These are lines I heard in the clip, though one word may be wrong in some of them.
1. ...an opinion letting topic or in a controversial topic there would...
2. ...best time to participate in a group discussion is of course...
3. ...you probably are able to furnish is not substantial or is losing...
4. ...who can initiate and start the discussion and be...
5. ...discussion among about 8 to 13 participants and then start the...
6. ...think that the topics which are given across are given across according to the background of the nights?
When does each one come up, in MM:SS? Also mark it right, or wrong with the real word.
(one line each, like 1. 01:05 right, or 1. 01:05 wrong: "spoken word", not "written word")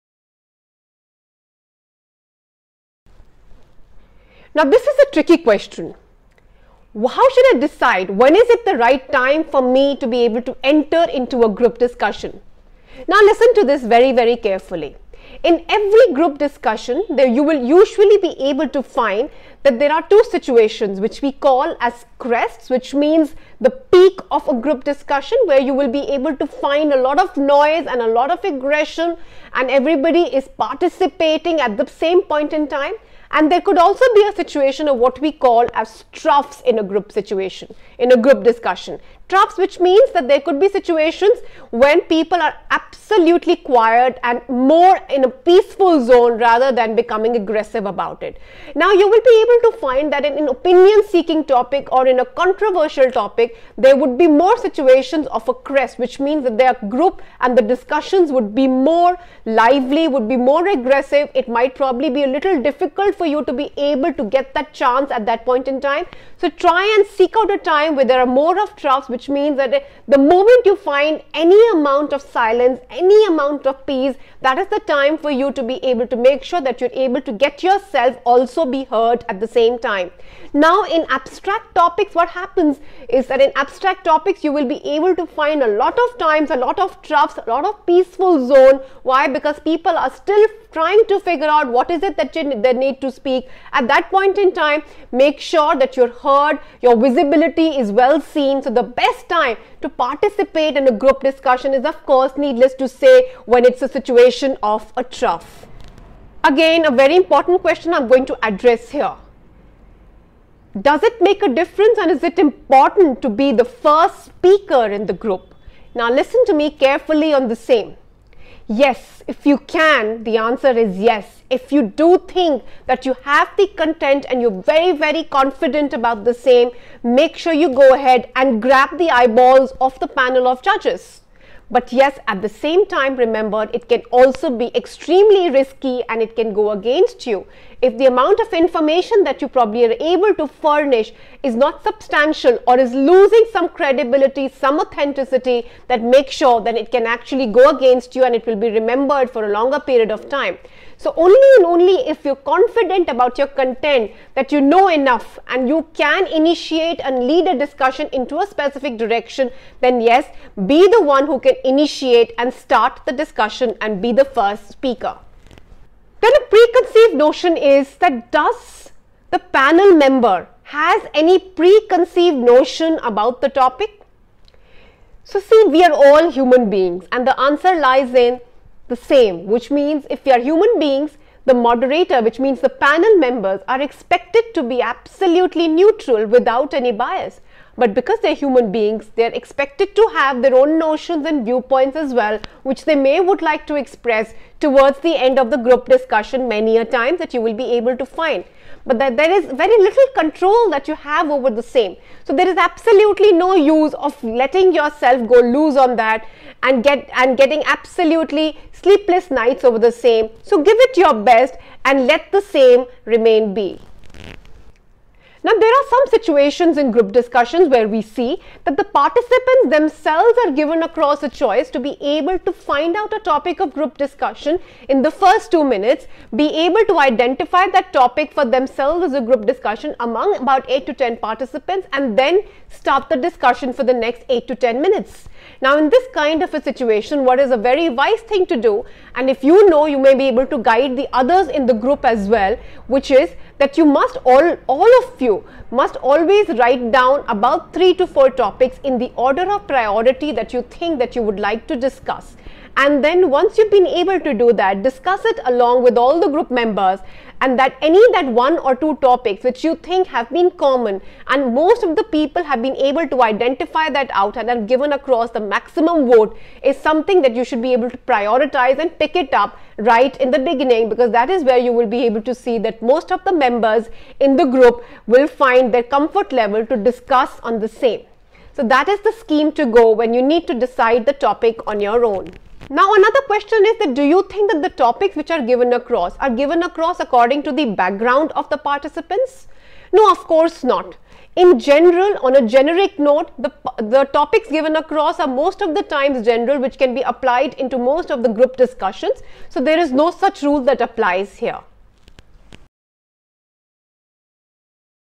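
1. 00:50 wrong: "seeking", not "letting"
2. 01:38 right
3. 02:19 right
4. 02:41 right
5. 03:49 wrong: "10", not "13"
6. 04:44 wrong: "participants", not "nights".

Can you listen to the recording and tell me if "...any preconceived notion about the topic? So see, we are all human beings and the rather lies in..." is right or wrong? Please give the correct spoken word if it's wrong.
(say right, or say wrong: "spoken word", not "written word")
wrong: "answer", not "rather".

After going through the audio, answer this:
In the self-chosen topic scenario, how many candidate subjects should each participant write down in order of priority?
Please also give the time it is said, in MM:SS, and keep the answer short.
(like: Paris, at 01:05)
3 to 4, at 04:07.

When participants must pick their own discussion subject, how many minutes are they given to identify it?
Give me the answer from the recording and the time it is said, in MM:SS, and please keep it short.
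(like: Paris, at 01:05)
2, at 03:45.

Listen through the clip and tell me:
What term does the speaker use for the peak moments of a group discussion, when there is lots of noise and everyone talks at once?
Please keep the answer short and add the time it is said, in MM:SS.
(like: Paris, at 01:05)
crests, at 00:22.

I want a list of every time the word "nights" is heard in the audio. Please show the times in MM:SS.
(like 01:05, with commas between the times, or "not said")
03:29.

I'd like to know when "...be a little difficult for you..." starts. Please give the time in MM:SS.
01:02.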